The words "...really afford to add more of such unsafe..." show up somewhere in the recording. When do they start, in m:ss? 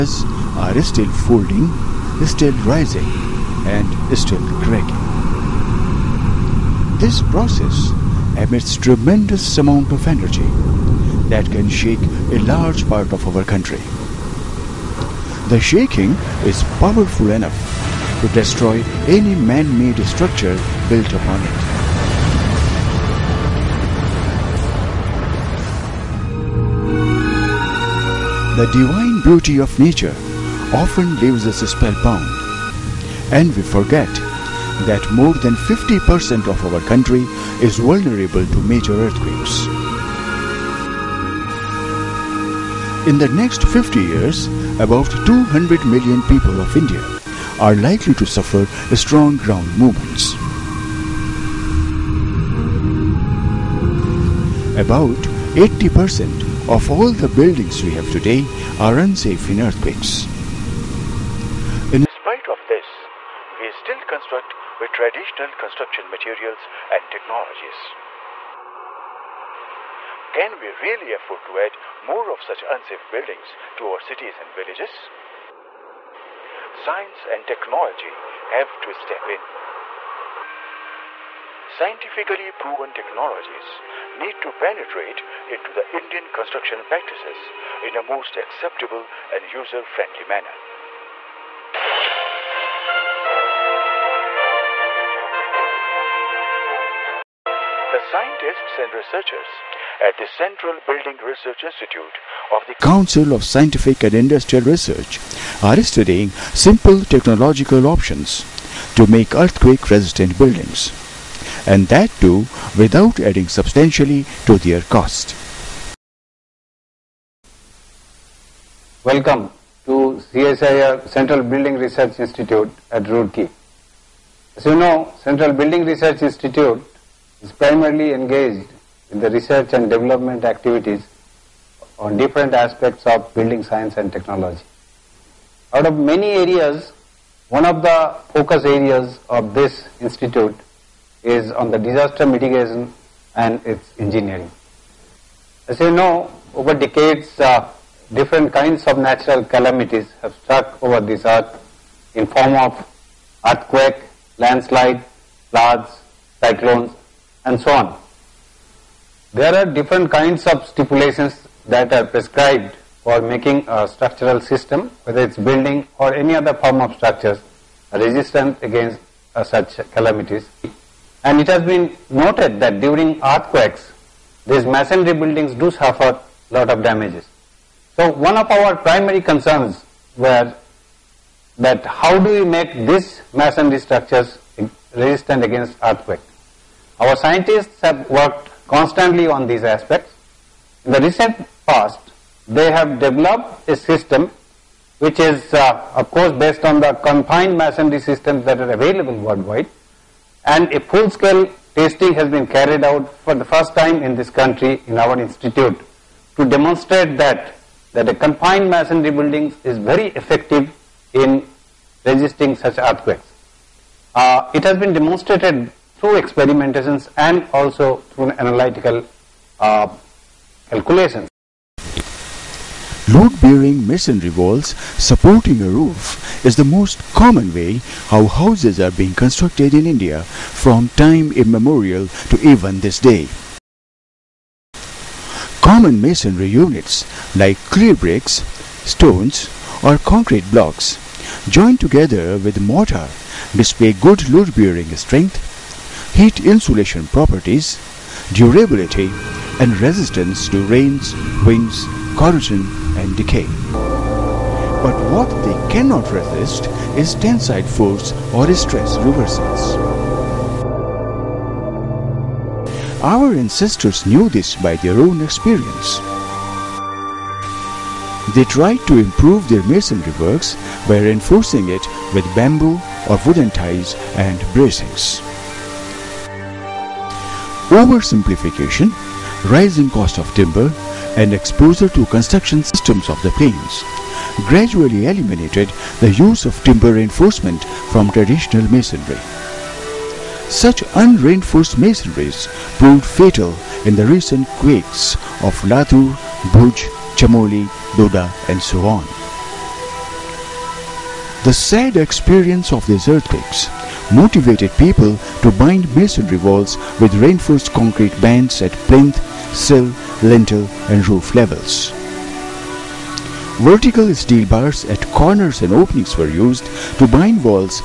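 1:10.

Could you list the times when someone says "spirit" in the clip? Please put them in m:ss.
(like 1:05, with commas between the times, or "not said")
not said.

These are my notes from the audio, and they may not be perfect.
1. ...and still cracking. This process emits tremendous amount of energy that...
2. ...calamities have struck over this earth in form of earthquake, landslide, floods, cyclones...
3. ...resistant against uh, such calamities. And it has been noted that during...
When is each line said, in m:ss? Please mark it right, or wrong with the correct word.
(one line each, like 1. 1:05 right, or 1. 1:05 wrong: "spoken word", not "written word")
1. 0:03 right
2. 2:29 right
3. 2:47 right.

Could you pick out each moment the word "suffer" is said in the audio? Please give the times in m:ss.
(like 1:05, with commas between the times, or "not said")
0:48, 2:55.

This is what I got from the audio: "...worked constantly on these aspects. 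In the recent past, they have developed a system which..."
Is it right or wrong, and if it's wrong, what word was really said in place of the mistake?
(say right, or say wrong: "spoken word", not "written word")
right.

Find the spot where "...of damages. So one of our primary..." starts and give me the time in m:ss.
2:56.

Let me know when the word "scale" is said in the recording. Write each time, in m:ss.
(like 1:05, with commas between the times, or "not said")
3:20.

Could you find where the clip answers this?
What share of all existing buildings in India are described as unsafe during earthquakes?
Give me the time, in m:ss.
0:55.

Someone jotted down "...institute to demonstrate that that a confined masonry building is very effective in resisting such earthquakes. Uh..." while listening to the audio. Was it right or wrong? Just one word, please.
right.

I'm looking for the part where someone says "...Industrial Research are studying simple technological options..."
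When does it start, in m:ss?
1:44.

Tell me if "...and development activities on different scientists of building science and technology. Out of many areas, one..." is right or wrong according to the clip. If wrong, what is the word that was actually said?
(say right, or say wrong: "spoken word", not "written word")
wrong: "aspects", not "scientists".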